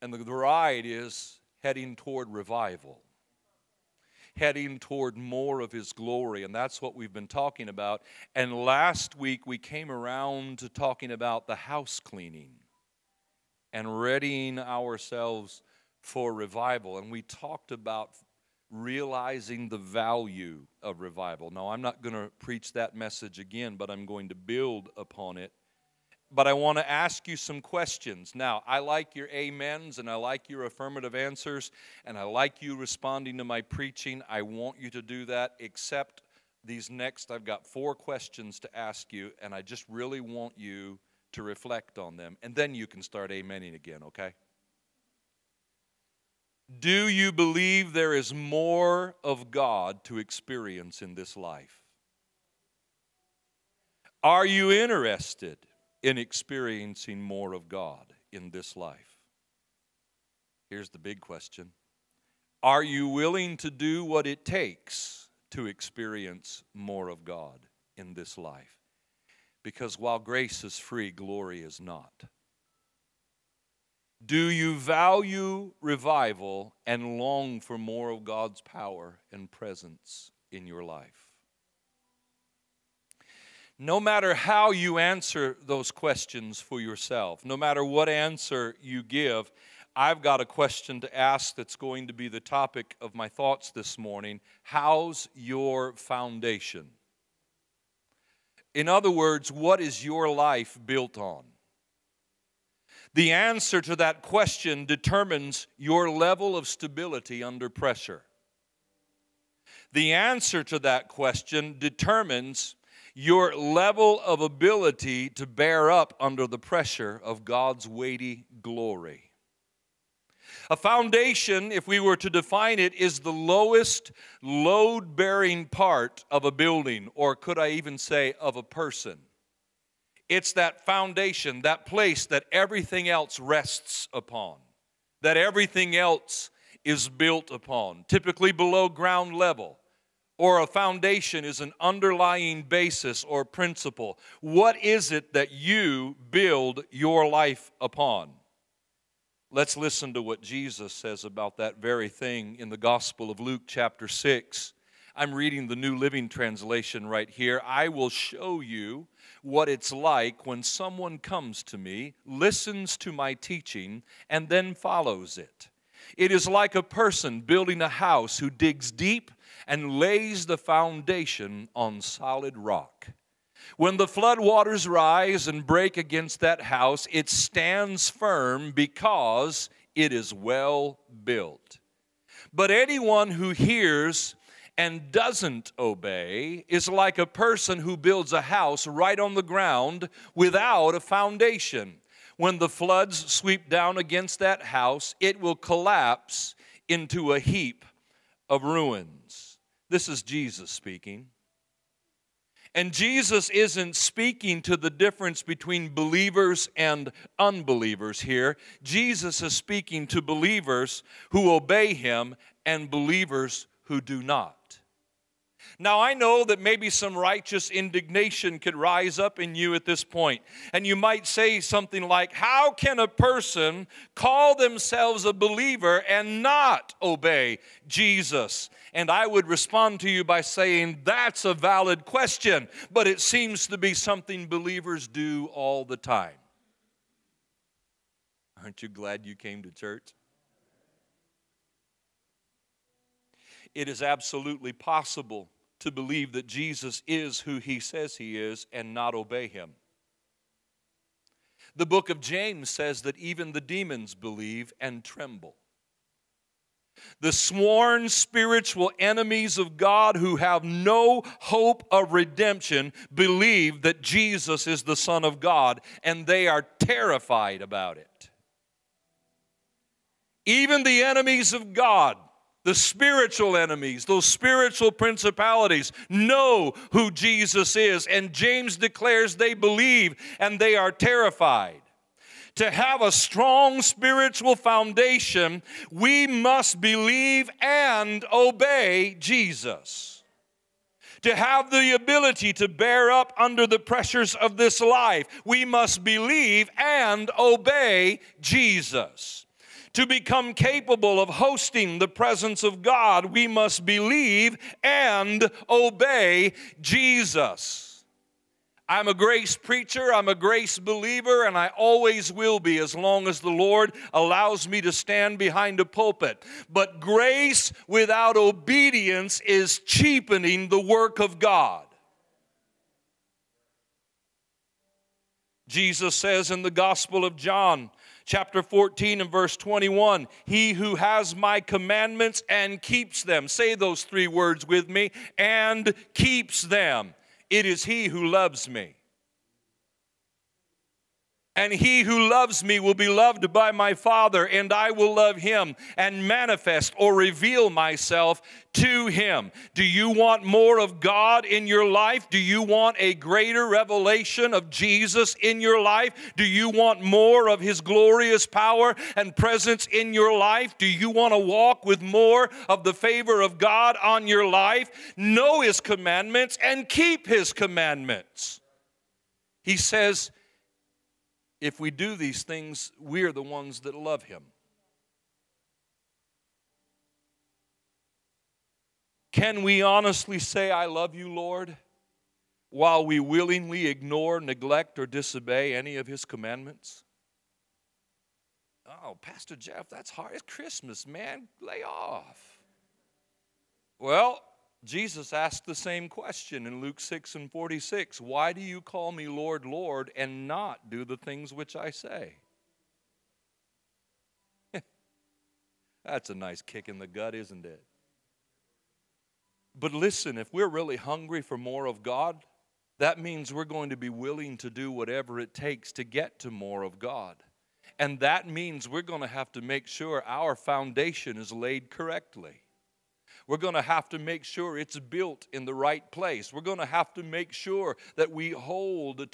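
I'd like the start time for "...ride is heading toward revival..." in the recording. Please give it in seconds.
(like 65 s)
0 s.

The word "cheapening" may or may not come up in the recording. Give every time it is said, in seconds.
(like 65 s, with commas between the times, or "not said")
319 s.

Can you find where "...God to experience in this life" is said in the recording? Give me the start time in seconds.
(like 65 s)
49 s.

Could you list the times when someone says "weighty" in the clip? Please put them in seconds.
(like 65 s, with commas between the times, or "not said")
117 s.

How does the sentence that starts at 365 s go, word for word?
Know his commandments and keep his commandments.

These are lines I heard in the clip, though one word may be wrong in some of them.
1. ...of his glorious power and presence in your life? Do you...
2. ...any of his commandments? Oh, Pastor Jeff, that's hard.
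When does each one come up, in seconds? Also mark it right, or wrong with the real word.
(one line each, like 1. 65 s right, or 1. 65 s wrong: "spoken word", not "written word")
1. 357 s right
2. 385 s right.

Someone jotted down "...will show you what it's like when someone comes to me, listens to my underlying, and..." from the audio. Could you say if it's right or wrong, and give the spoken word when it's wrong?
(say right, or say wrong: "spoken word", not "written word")
wrong: "teaching", not "underlying".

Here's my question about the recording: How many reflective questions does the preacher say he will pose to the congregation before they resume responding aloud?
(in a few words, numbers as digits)
4.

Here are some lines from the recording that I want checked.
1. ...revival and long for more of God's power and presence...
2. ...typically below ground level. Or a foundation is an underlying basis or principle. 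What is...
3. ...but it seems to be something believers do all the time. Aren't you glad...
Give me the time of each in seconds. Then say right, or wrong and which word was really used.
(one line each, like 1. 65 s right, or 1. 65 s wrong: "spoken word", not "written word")
1. 75 s right
2. 138 s right
3. 232 s right.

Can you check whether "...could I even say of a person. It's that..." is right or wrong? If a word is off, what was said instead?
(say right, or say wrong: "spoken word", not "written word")
right.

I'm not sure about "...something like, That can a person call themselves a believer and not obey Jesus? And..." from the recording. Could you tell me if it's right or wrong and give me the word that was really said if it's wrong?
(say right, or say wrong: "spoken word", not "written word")
wrong: "How", not "That".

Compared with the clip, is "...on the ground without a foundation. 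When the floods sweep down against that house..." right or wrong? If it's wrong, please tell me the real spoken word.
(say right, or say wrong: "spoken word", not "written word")
right.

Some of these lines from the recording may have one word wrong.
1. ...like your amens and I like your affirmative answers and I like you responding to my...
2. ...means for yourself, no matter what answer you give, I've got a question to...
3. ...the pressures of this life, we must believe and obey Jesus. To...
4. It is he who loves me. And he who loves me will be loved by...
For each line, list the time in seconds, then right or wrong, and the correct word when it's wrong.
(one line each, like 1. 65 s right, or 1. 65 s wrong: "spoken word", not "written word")
1. 28 s right
2. 85 s wrong: "questions", not "means"
3. 293 s right
4. 337 s right.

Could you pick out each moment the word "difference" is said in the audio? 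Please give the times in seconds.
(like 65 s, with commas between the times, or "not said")
204 s.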